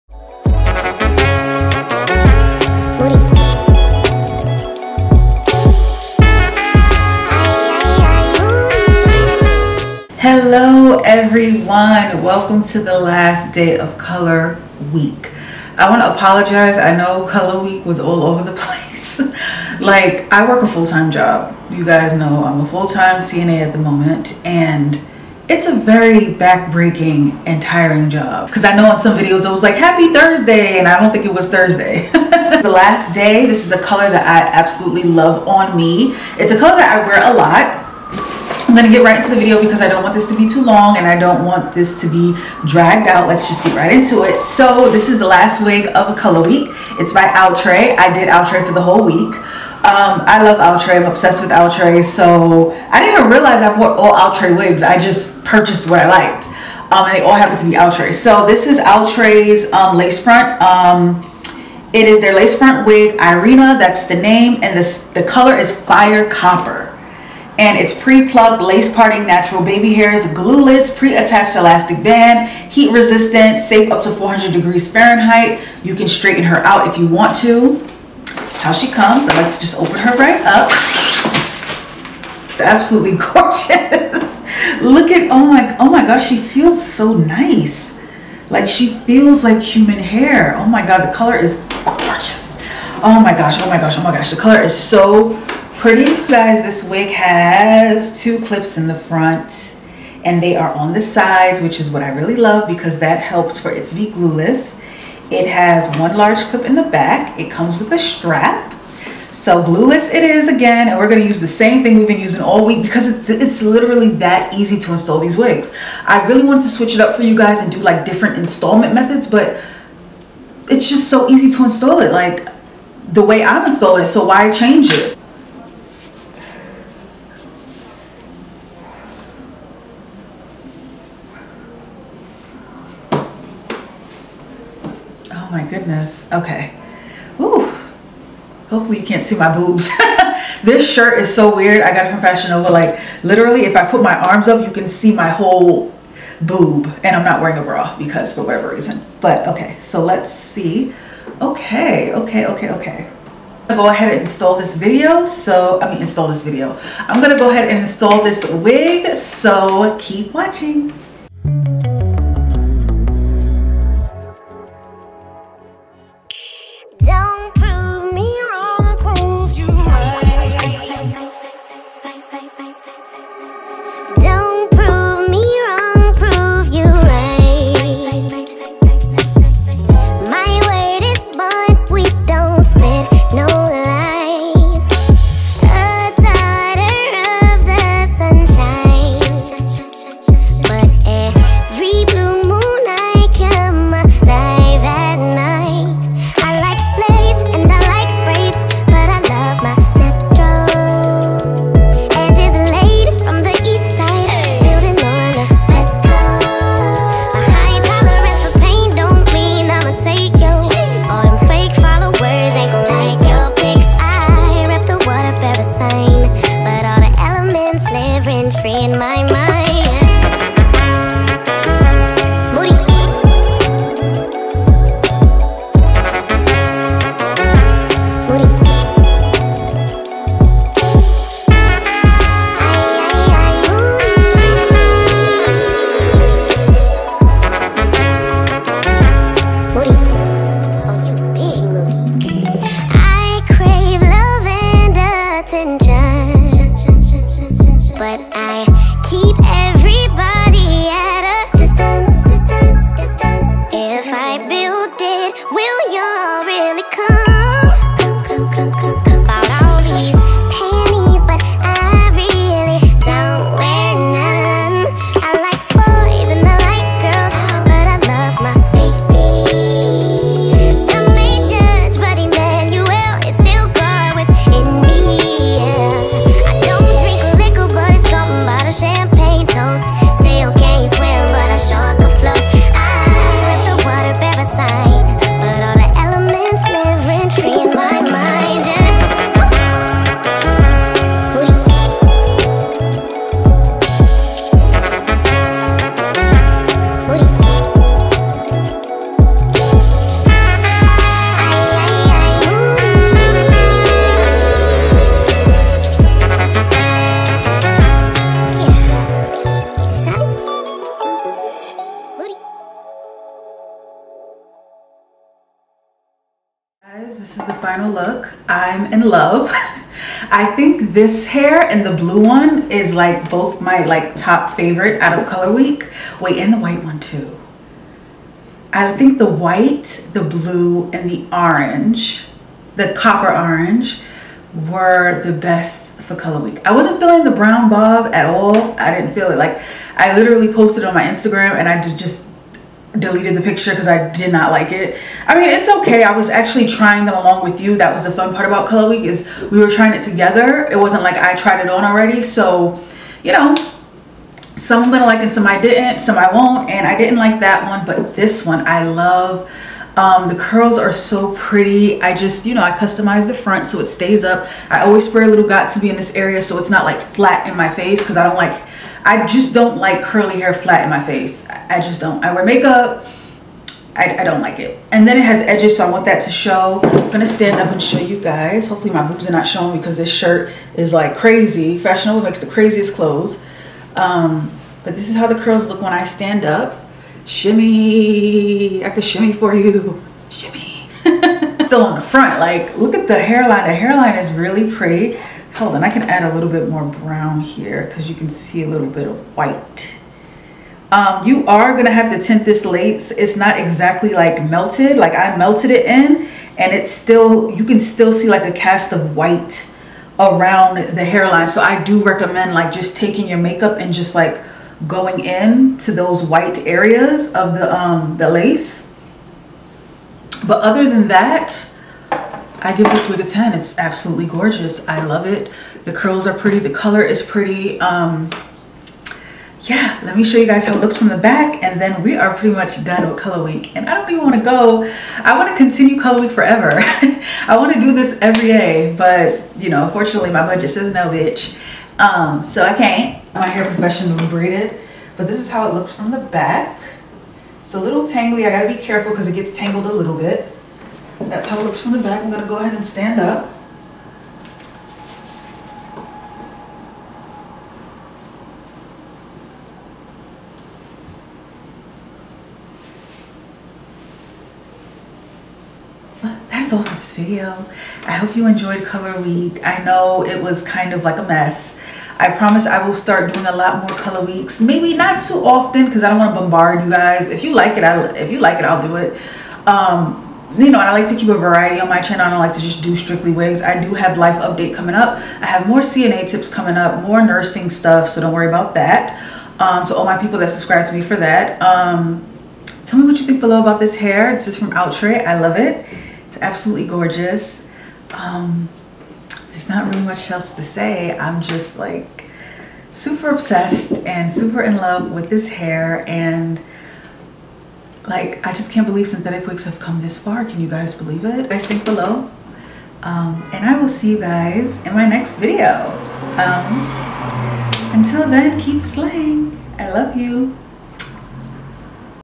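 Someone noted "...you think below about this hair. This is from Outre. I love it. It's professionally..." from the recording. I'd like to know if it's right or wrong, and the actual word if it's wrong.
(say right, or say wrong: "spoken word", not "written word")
wrong: "absolutely", not "professionally".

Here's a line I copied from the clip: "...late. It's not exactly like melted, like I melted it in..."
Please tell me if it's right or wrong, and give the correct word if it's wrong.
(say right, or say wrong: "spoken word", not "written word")
right.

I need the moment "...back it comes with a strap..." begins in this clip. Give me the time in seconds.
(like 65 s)
106 s.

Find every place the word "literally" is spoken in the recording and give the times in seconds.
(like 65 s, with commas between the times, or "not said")
113 s, 143 s, 340 s.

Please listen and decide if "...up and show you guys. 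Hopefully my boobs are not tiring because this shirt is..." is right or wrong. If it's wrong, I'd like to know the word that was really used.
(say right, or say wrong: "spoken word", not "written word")
wrong: "showing", not "tiring".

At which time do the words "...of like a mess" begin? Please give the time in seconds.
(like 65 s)
470 s.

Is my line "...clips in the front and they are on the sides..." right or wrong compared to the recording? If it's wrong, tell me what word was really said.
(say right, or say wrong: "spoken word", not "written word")
right.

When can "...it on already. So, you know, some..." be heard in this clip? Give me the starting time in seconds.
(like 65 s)
351 s.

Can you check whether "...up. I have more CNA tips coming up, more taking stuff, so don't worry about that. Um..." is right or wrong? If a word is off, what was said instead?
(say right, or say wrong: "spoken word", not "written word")
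wrong: "nursing", not "taking".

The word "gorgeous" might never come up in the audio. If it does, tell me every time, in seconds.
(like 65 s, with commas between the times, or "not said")
83 s, 91 s, 424 s, 496 s.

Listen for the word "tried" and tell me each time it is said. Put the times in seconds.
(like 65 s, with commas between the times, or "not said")
351 s.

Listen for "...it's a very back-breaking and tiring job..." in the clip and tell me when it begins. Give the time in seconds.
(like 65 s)
25 s.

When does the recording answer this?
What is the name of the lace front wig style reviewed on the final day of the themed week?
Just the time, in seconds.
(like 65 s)
63 s.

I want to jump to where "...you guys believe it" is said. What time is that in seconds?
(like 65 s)
510 s.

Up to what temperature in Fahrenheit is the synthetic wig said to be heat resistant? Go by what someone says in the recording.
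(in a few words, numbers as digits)
400 degrees.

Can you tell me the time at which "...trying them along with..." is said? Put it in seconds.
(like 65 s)
346 s.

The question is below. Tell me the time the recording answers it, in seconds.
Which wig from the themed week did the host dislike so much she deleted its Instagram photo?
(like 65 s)
337 s.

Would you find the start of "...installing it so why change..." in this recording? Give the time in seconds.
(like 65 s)
123 s.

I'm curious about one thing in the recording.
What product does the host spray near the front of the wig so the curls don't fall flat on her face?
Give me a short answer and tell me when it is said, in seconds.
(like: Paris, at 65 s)
Got2b, at 365 s.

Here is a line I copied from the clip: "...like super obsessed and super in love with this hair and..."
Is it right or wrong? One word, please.
right.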